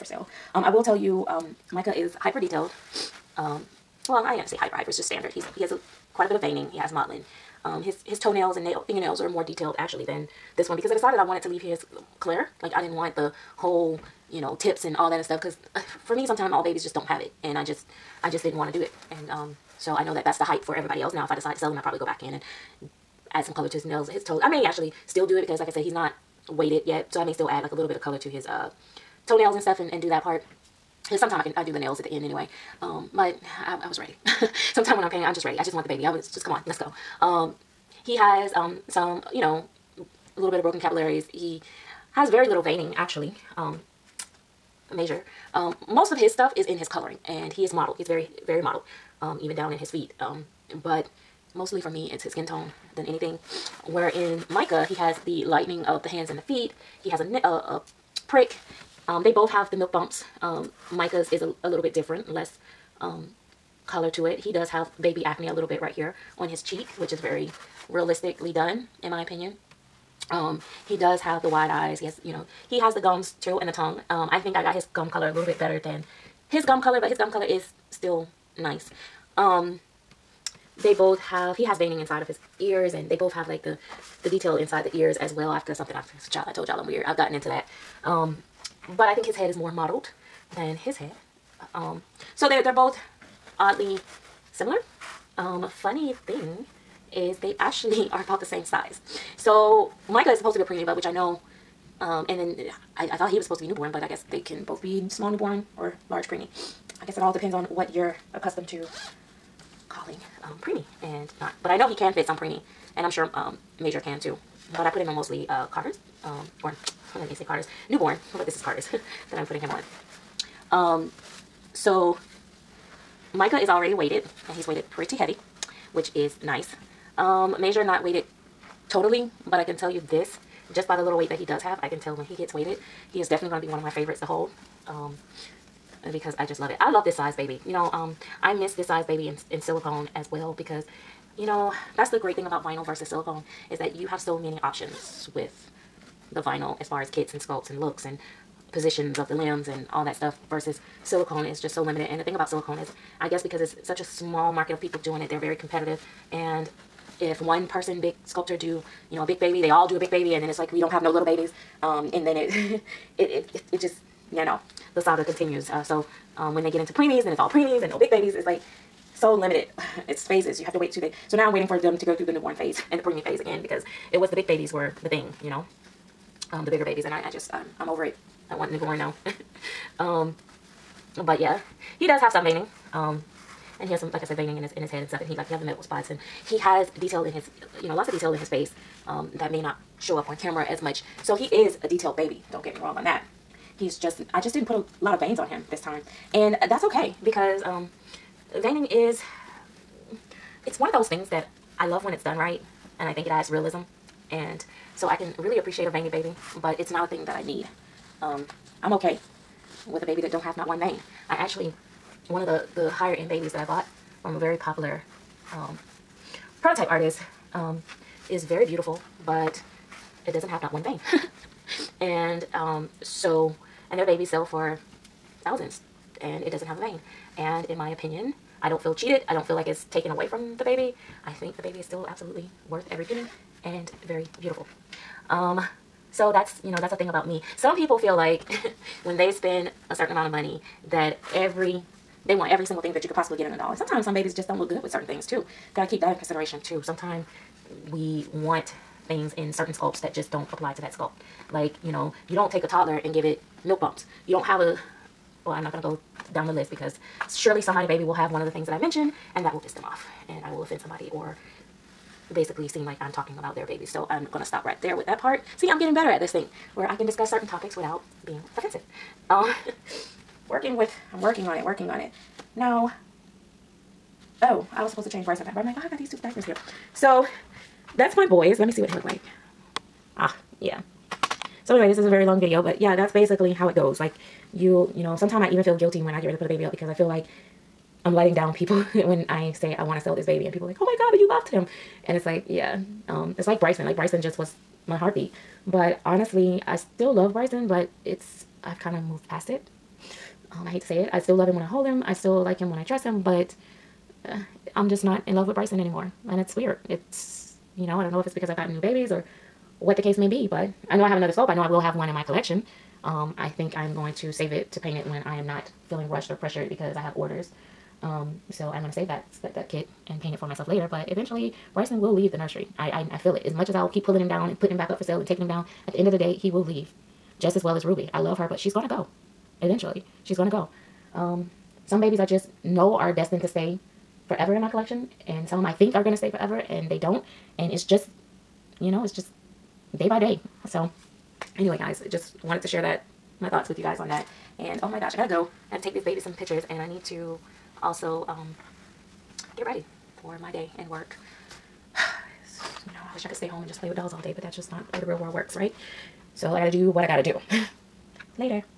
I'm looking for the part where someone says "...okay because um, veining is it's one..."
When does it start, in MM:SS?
03:16.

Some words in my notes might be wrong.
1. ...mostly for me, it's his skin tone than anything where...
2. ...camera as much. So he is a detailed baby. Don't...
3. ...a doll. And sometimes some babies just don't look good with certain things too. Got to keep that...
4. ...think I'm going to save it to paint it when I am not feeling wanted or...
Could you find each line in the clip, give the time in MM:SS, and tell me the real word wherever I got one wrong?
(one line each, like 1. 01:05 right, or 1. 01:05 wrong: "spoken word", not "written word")
1. 00:51 right
2. 03:10 right
3. 04:03 right
4. 05:13 wrong: "rushed", not "wanted".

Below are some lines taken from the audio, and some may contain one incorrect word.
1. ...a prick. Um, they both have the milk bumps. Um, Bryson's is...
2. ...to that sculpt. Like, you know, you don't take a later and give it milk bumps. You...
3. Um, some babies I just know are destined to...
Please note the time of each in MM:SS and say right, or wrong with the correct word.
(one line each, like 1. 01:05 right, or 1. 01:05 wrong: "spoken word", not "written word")
1. 00:57 wrong: "Micah", not "Bryson"
2. 04:10 wrong: "toddler", not "later"
3. 05:31 right.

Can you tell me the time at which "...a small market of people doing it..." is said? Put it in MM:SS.
02:33.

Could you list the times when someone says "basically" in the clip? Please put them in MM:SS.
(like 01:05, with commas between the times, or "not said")
04:22, 04:43.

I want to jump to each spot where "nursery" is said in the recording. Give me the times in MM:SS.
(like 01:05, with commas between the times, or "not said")
05:22.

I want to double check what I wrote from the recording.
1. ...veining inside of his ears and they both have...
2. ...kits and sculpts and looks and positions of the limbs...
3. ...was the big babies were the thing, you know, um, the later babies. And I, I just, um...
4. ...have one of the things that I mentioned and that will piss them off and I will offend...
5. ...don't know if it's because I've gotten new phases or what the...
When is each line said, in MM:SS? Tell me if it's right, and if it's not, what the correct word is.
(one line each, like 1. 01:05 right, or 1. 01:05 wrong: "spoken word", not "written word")
1. 01:21 right
2. 02:27 right
3. 02:54 wrong: "bigger", not "later"
4. 04:18 right
5. 05:08 wrong: "babies", not "phases".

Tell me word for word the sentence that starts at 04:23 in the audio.
So I'm gonna stop right there with that part.